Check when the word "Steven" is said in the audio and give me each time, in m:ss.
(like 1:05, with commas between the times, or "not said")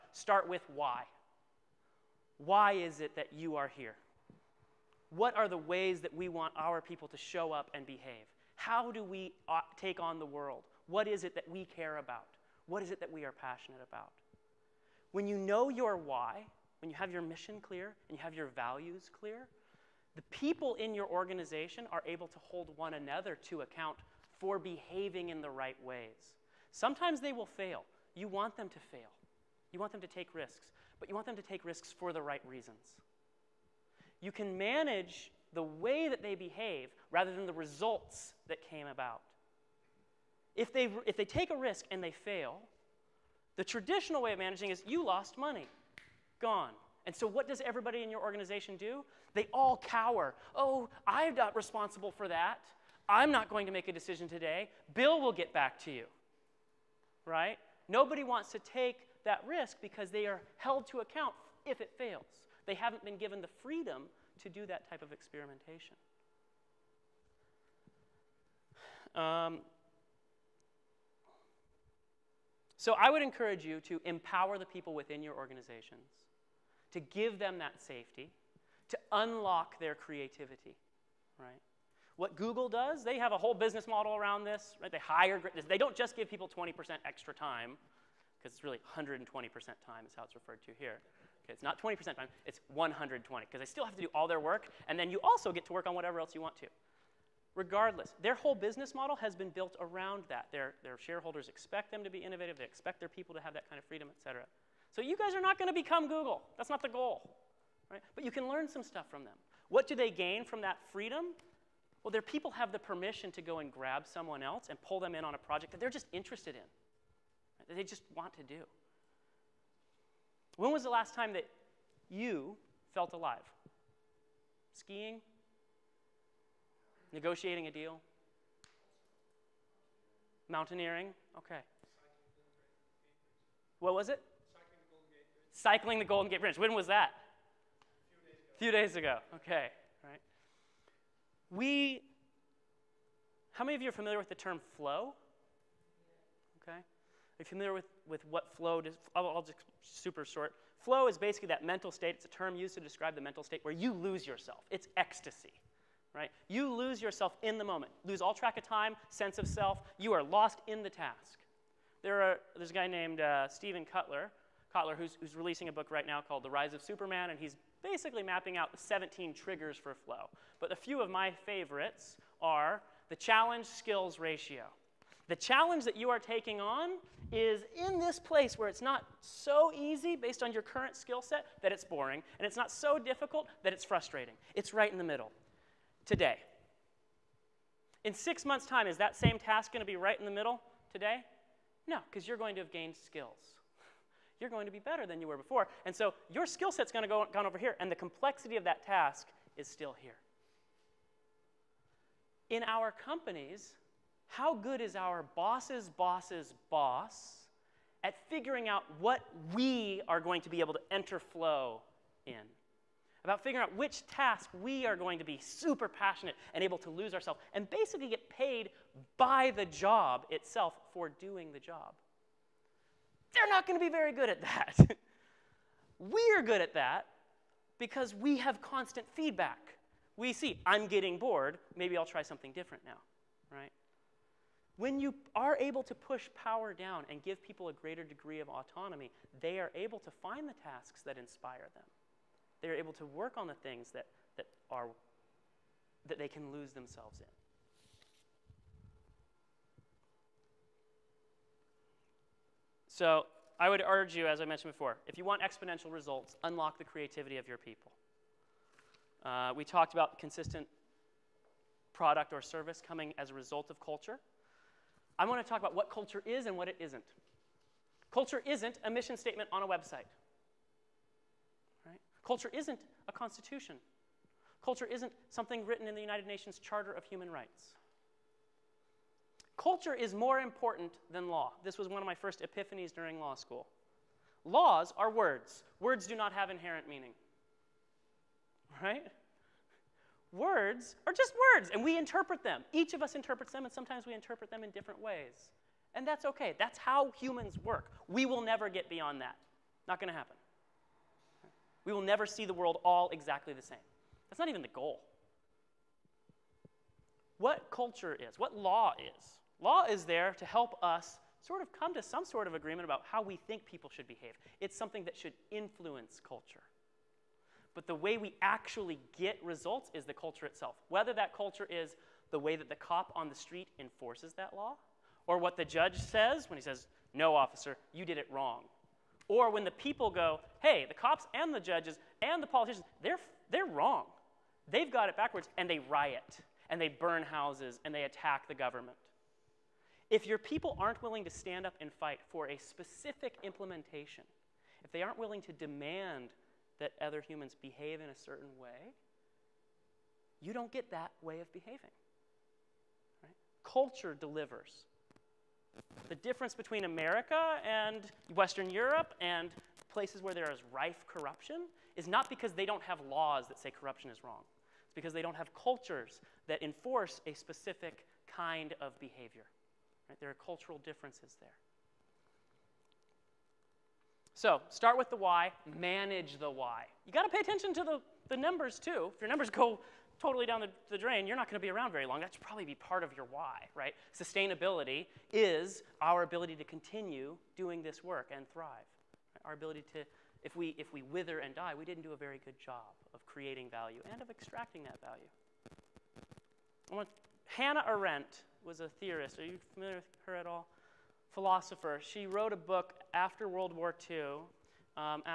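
2:43.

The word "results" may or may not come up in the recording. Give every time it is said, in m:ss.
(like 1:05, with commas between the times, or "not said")
0:37, 4:15, 4:23, 5:19.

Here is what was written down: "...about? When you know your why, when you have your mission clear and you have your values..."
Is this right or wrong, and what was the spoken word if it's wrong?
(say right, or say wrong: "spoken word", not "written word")
right.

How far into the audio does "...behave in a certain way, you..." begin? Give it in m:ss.
5:47.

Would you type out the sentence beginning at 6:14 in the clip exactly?
So start with the why, manage the why.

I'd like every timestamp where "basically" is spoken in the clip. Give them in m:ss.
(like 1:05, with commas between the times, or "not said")
2:31, 2:47, 3:37.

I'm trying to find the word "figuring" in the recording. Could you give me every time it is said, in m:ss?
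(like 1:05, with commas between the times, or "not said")
3:28, 3:33.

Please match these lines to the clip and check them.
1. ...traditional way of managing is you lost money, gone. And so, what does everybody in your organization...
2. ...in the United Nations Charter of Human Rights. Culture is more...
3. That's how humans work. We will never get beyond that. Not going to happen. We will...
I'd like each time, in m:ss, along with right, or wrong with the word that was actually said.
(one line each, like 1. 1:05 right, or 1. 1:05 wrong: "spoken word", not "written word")
1. 0:43 right
2. 4:35 right
3. 4:56 right.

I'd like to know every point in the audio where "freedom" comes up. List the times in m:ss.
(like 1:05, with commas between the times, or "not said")
1:03, 1:43, 1:50.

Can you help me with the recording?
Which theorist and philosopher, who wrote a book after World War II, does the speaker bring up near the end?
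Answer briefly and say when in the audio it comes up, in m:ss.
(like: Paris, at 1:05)
Hannah Arendt, at 6:37.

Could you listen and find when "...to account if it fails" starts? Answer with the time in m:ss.
1:00.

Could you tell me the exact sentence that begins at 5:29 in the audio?
Or when the people go, hey, the cops and the judges and the politicians, they're, they're wrong.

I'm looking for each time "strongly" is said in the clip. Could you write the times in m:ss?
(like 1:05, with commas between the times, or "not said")
not said.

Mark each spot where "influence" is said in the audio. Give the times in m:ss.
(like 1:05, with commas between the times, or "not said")
5:15.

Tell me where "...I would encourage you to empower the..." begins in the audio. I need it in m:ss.
1:12.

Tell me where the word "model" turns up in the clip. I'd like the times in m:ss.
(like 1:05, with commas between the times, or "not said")
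1:23, 1:38.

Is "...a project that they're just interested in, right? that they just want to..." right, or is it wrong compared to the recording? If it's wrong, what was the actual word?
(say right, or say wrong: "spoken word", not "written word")
right.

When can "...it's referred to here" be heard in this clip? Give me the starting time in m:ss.
1:30.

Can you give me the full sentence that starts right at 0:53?
I'm not going to make a decision today.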